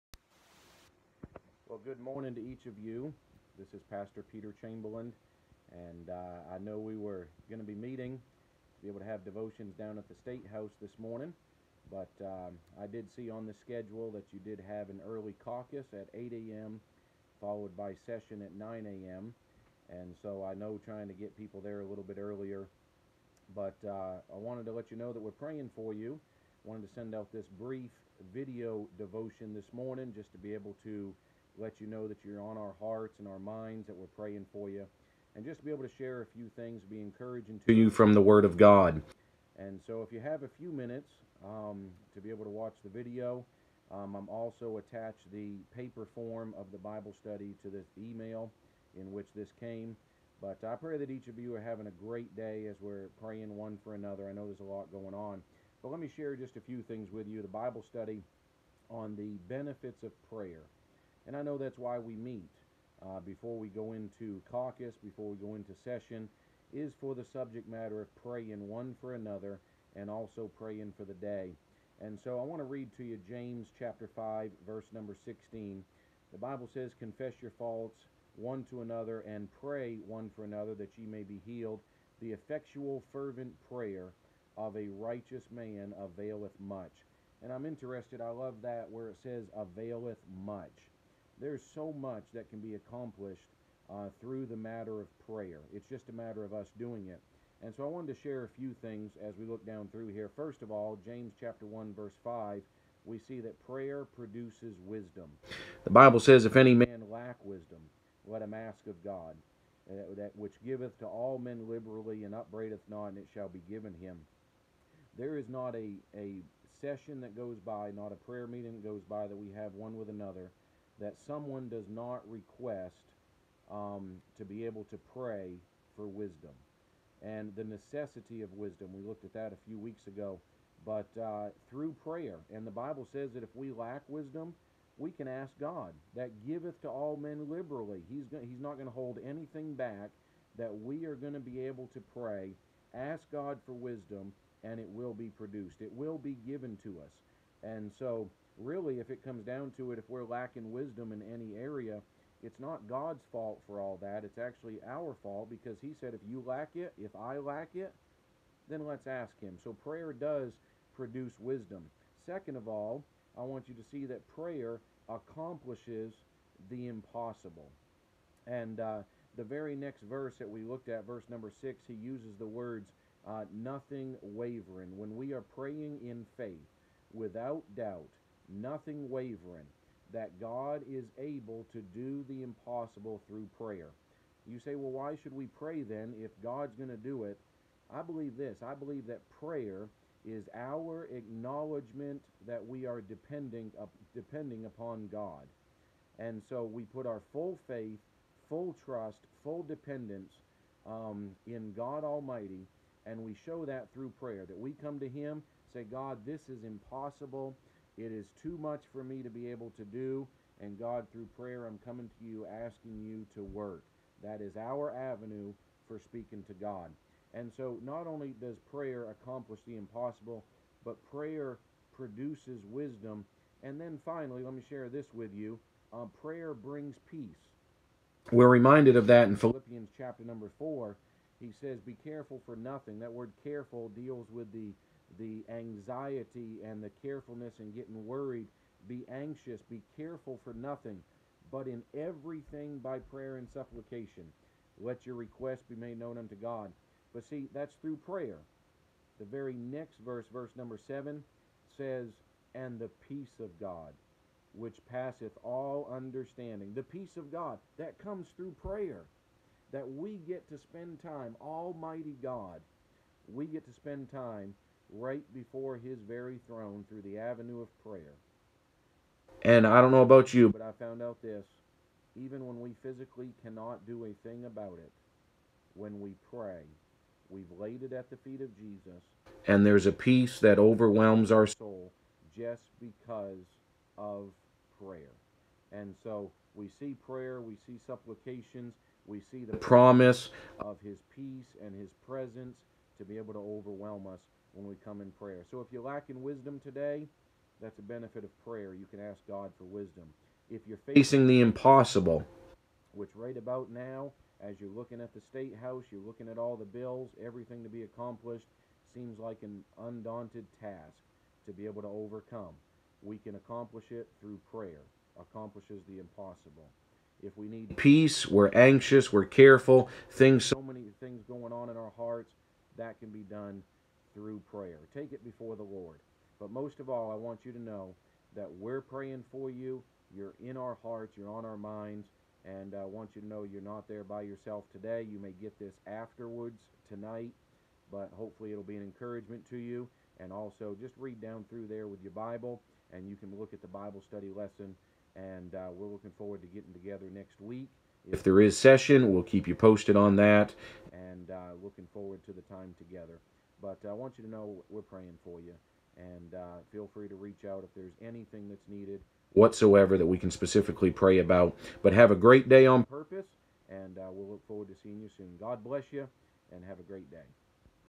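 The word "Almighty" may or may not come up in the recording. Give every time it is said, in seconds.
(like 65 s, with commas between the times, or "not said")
202 s, 261 s.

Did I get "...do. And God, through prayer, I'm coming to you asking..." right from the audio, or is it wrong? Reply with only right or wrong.
right.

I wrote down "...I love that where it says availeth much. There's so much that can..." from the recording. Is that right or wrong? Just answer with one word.
right.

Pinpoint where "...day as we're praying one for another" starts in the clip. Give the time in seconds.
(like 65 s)
52 s.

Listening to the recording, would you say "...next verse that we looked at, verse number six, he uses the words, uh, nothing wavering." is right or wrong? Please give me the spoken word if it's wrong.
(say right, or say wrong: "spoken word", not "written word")
right.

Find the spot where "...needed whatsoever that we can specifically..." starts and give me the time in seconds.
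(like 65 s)
358 s.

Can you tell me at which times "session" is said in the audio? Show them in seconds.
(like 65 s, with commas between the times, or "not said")
18 s, 65 s, 116 s, 348 s.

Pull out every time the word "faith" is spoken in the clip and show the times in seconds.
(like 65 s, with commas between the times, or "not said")
176 s, 197 s.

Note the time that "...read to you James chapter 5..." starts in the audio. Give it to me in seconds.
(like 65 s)
72 s.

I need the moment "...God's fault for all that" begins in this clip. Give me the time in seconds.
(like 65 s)
152 s.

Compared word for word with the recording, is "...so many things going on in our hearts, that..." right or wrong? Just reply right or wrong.
right.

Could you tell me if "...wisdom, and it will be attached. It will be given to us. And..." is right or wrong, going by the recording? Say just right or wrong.
wrong.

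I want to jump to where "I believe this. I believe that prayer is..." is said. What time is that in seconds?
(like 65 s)
187 s.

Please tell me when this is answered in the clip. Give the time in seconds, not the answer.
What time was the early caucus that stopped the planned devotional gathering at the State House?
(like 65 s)
16 s.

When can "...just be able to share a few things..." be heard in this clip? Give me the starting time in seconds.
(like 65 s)
35 s.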